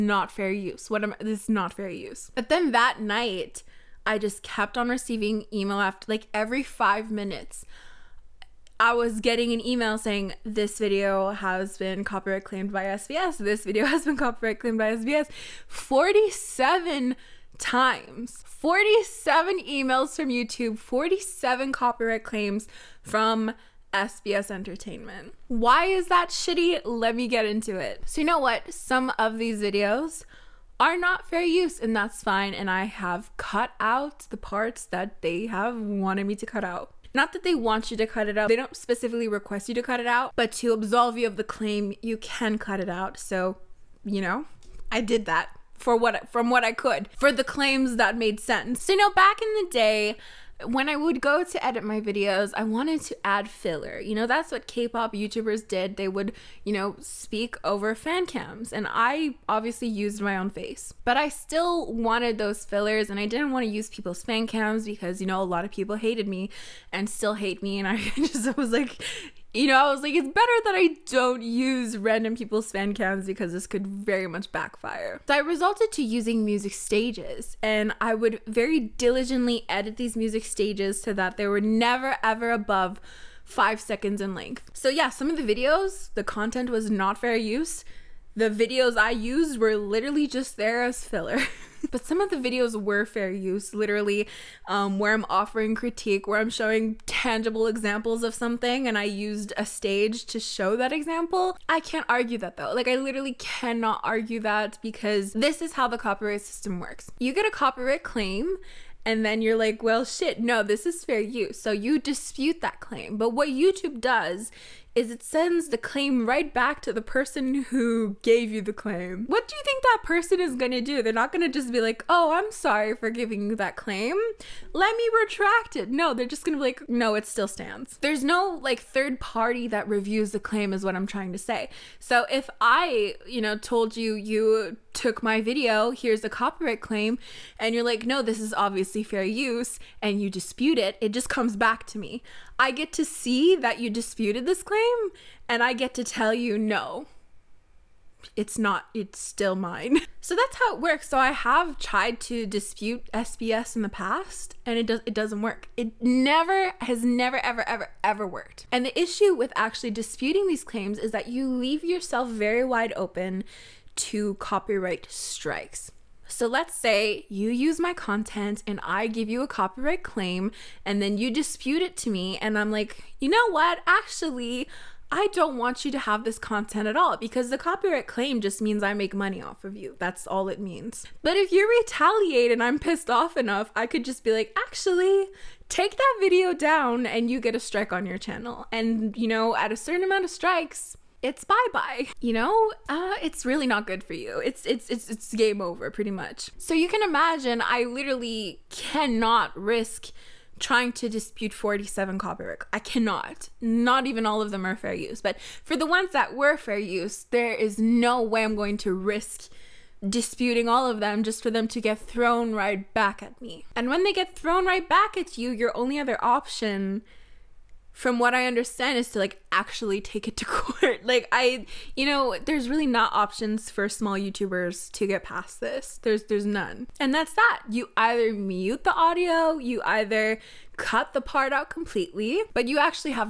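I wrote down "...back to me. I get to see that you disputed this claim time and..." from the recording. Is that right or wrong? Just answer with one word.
right.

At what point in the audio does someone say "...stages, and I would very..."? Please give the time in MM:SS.
01:16.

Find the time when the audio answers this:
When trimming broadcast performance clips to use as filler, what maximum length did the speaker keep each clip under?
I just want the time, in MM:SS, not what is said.
01:23.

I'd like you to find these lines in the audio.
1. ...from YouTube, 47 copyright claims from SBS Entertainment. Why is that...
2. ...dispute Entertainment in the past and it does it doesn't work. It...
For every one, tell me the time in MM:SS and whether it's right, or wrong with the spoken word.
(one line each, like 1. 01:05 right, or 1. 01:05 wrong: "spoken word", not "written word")
1. 00:20 right
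2. 02:32 wrong: "SBS", not "Entertainment".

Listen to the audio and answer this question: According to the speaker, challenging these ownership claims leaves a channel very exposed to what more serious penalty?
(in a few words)
Copyright strikes.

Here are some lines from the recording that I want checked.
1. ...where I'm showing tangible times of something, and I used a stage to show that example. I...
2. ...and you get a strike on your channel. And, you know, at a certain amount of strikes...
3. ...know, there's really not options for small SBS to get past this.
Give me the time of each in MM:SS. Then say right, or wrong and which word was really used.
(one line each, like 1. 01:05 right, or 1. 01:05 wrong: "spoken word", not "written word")
1. 01:36 wrong: "examples", not "times"
2. 03:07 right
3. 03:42 wrong: "YouTubers", not "SBS".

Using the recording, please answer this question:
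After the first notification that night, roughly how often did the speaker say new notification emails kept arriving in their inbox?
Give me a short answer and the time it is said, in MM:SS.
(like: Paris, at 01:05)
Every five minutes, at 00:06.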